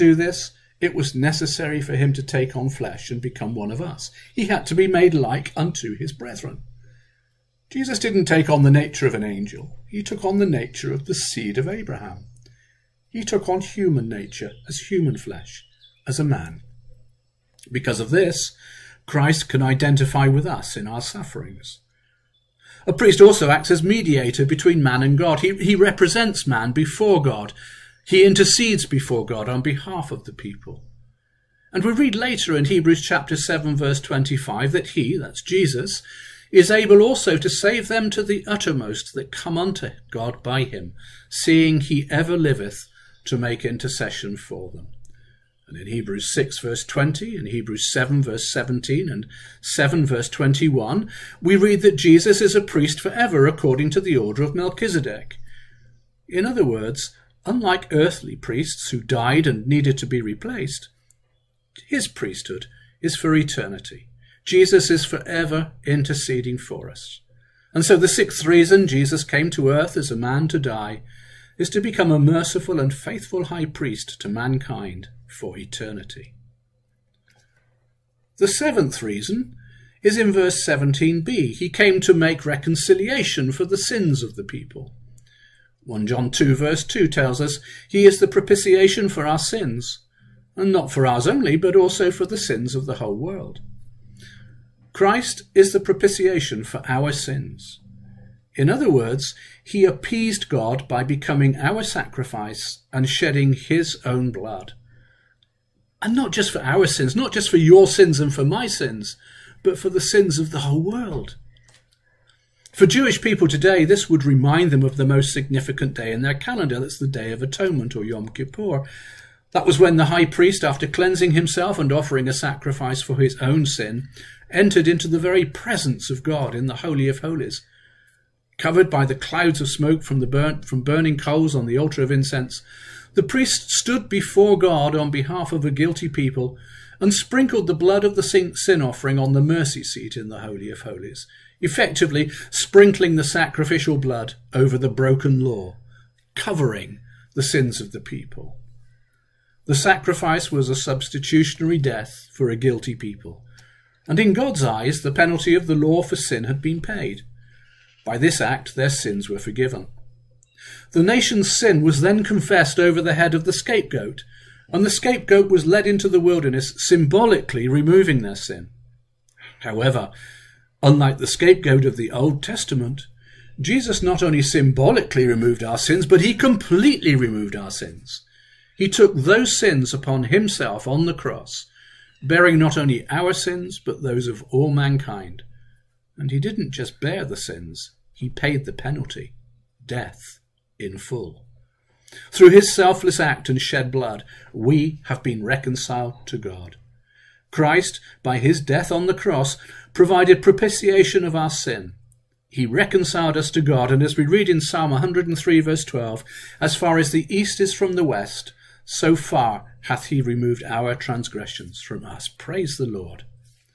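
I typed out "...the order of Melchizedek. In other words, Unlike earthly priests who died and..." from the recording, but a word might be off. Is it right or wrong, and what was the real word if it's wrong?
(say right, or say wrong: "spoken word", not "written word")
right.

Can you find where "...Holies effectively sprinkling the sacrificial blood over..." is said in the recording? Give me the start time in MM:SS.
02:20.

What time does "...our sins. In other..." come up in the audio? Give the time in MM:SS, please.
01:36.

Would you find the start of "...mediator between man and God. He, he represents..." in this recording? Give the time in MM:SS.
00:23.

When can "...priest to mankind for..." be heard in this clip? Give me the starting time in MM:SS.
01:13.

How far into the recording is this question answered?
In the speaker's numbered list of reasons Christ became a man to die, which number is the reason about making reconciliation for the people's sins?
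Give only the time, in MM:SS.
01:18.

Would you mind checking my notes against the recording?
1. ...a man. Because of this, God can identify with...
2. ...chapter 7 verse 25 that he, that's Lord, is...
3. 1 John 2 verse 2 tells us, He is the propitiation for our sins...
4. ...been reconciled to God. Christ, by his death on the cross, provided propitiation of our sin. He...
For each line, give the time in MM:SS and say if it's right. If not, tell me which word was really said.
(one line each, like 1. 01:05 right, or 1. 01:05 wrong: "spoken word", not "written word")
1. 00:16 wrong: "Christ", not "God"
2. 00:33 wrong: "Jesus", not "Lord"
3. 01:25 right
4. 03:15 right.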